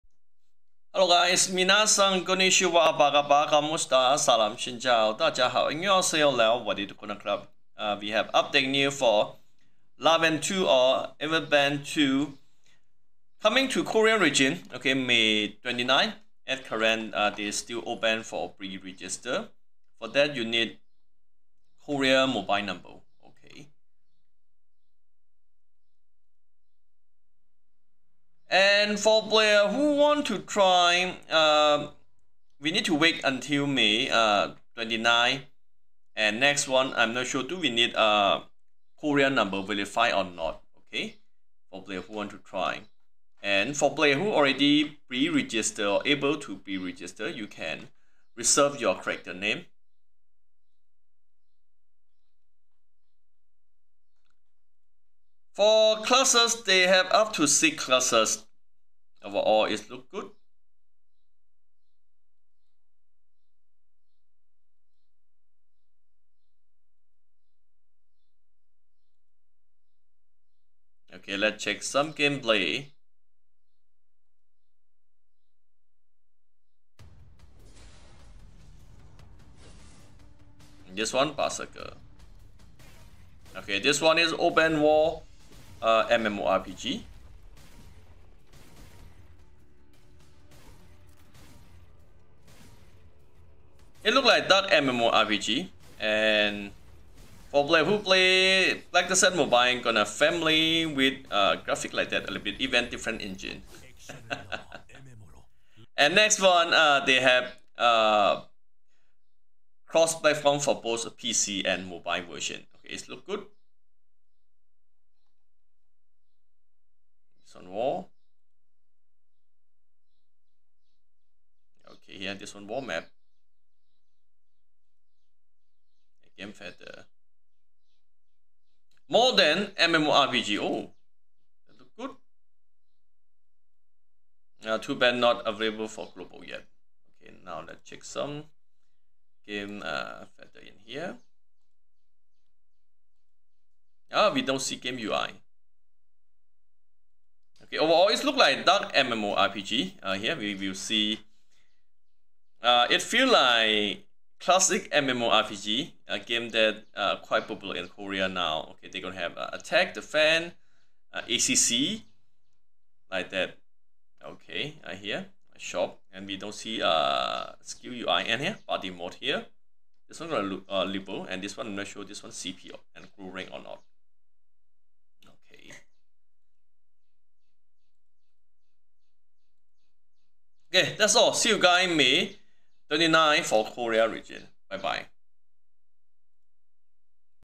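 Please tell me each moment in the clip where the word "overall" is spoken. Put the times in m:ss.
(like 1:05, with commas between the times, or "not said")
0:59, 2:27.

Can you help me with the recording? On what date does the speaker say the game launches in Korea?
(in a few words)
May 29.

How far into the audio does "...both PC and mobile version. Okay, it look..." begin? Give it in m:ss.
1:50.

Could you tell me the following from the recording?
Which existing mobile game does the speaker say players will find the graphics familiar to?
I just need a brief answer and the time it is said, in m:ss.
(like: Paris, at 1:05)
Black Desert mobile, at 1:38.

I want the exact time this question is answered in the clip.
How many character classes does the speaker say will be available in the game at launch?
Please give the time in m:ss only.
0:57.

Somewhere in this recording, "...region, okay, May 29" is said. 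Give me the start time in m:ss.
0:14.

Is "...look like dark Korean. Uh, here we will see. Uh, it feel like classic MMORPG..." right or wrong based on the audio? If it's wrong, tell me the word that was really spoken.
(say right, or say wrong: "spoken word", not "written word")
wrong: "MMORPG", not "Korean".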